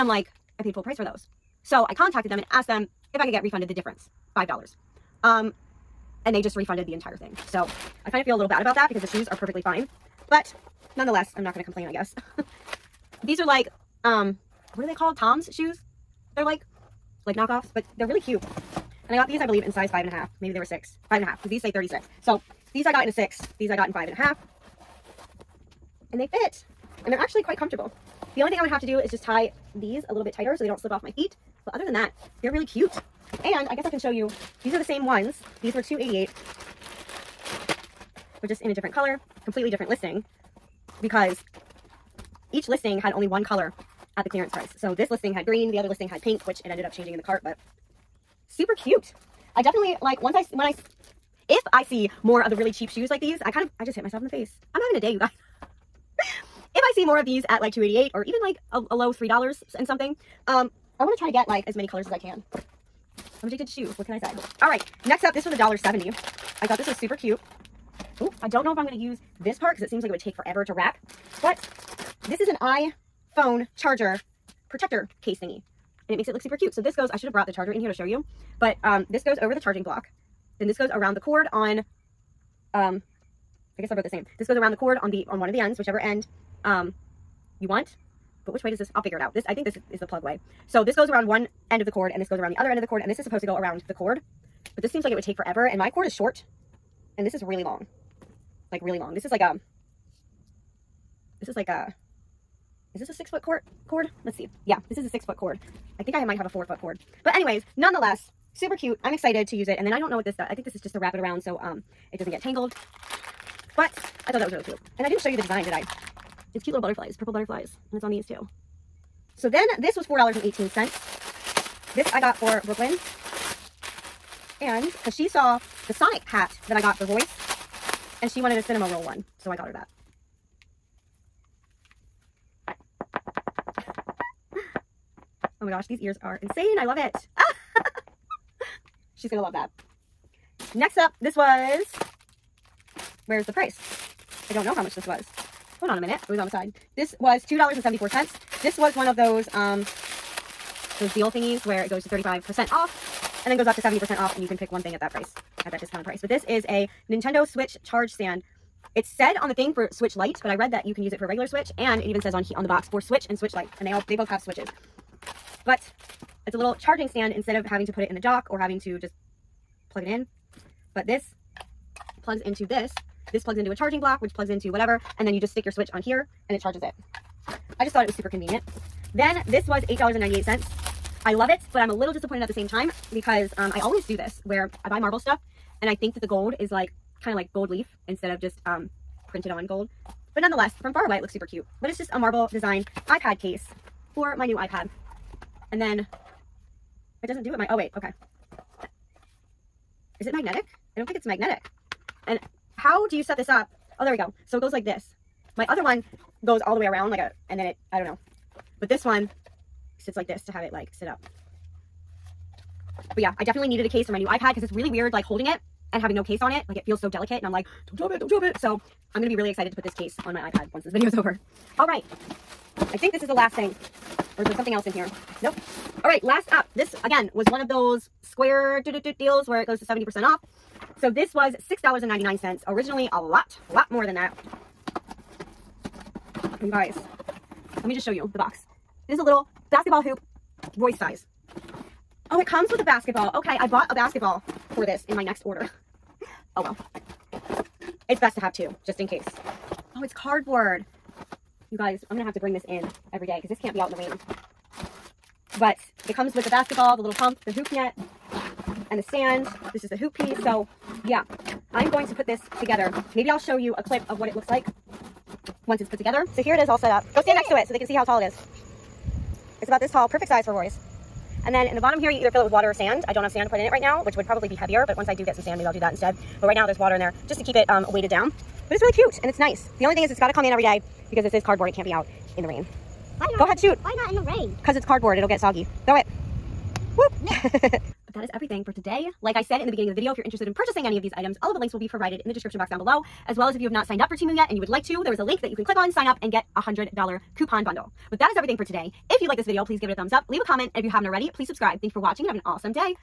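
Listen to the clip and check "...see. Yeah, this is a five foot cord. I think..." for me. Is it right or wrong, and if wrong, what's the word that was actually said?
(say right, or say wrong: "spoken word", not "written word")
wrong: "six", not "five".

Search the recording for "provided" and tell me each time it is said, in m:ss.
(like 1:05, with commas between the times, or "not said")
4:51.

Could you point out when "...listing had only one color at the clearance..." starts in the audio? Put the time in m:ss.
0:42.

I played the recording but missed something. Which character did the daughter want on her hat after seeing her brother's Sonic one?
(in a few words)
Cinnamoroll.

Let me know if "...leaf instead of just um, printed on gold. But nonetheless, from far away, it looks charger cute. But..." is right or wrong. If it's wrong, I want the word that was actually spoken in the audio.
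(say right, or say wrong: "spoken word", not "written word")
wrong: "super", not "charger".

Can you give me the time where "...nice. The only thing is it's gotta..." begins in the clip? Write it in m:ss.
4:39.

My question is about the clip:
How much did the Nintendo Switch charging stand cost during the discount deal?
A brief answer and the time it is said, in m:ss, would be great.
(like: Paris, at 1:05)
$2.74, at 2:27.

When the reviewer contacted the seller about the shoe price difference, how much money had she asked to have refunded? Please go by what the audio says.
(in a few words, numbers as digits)
$5.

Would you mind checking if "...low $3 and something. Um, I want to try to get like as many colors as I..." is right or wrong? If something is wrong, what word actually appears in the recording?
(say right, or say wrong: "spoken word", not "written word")
right.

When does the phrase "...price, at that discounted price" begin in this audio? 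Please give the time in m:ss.
2:35.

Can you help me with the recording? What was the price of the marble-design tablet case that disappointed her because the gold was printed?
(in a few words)
$8.98.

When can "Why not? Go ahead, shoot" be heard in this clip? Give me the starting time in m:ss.
4:43.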